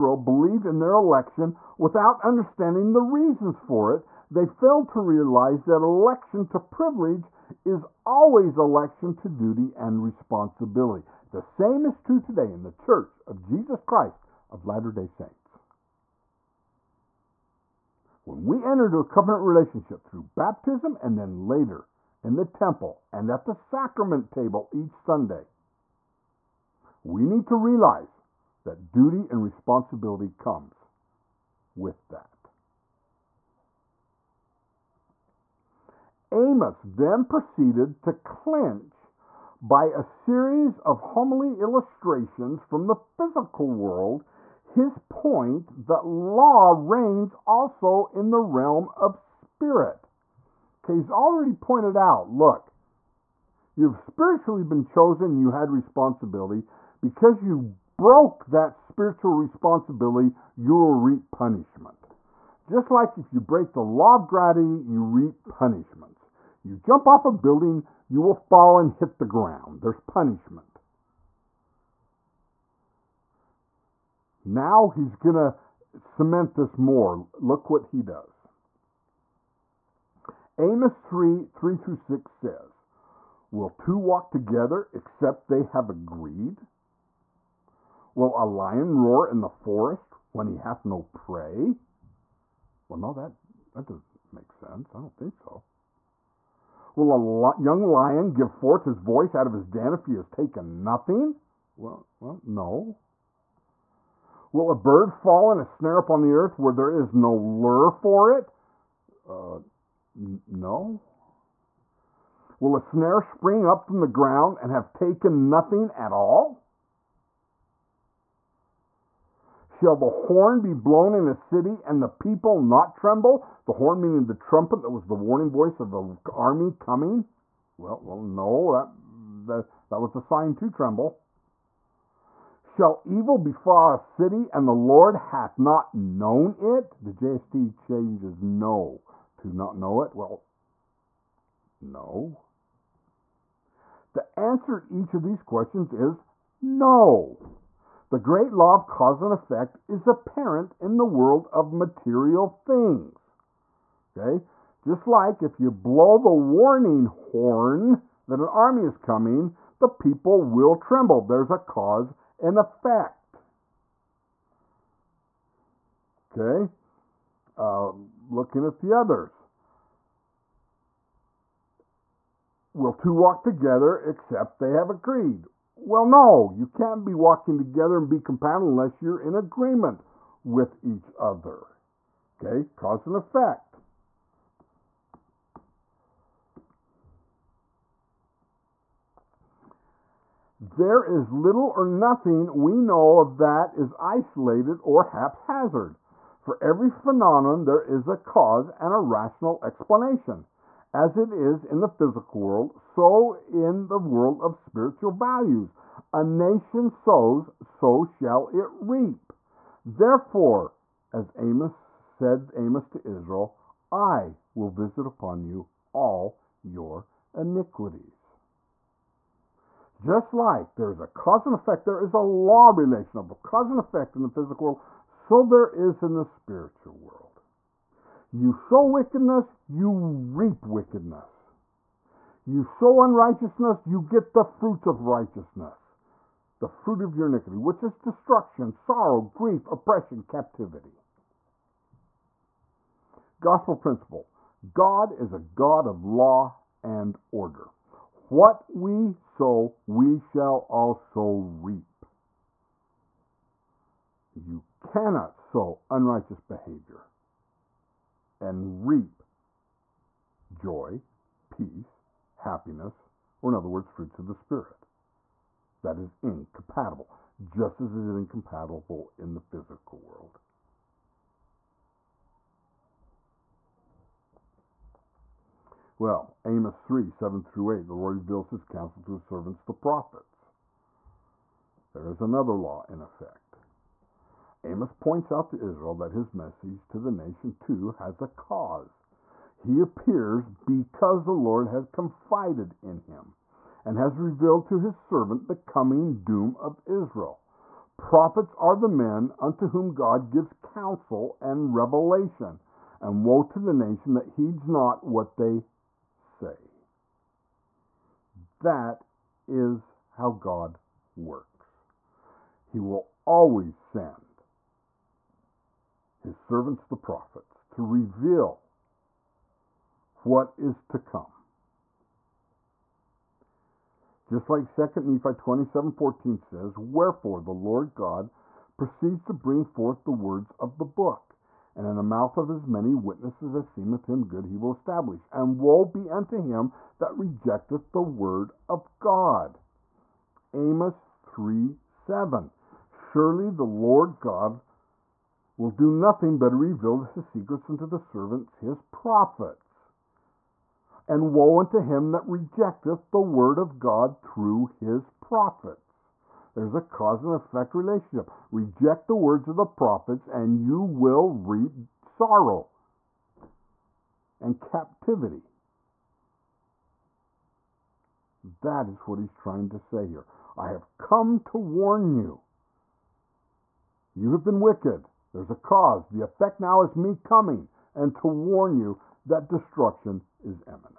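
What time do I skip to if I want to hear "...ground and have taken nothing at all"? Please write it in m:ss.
1:54.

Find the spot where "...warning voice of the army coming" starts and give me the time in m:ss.
2:05.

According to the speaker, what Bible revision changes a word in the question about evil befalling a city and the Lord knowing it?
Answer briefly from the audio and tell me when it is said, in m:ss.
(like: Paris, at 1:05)
JST, at 2:17.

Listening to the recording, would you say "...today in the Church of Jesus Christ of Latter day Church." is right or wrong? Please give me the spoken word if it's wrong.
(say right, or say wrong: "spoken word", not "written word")
wrong: "Saints", not "Church".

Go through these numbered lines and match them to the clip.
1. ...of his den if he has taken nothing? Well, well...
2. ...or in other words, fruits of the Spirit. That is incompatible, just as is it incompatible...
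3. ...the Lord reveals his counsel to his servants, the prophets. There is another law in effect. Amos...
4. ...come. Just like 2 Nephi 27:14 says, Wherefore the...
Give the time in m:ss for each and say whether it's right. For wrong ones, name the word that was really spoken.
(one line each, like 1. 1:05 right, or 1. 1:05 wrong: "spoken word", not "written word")
1. 1:39 right
2. 4:23 right
3. 4:37 right
4. 5:20 right.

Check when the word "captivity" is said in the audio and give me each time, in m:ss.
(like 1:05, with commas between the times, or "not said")
4:00, 6:04.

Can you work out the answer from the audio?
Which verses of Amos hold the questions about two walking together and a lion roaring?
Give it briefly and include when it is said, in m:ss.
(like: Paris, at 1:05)
Amos 3:3-6, at 1:20.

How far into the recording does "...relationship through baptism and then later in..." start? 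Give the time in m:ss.
0:19.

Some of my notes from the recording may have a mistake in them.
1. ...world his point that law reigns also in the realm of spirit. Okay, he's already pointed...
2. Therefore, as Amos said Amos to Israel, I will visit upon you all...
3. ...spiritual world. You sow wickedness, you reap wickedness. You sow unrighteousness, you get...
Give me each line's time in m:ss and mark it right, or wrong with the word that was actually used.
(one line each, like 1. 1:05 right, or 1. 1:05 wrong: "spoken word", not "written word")
1. 0:43 right
2. 3:29 right
3. 3:46 right.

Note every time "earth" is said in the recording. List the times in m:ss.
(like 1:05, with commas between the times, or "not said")
1:46.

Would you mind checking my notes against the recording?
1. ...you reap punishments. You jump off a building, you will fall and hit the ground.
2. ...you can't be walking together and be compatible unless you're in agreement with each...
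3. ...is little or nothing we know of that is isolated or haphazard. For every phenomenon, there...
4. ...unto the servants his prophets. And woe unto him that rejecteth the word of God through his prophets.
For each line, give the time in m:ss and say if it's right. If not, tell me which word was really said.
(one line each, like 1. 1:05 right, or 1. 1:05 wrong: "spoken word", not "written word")
1. 1:04 right
2. 2:56 right
3. 3:11 right
4. 5:47 right.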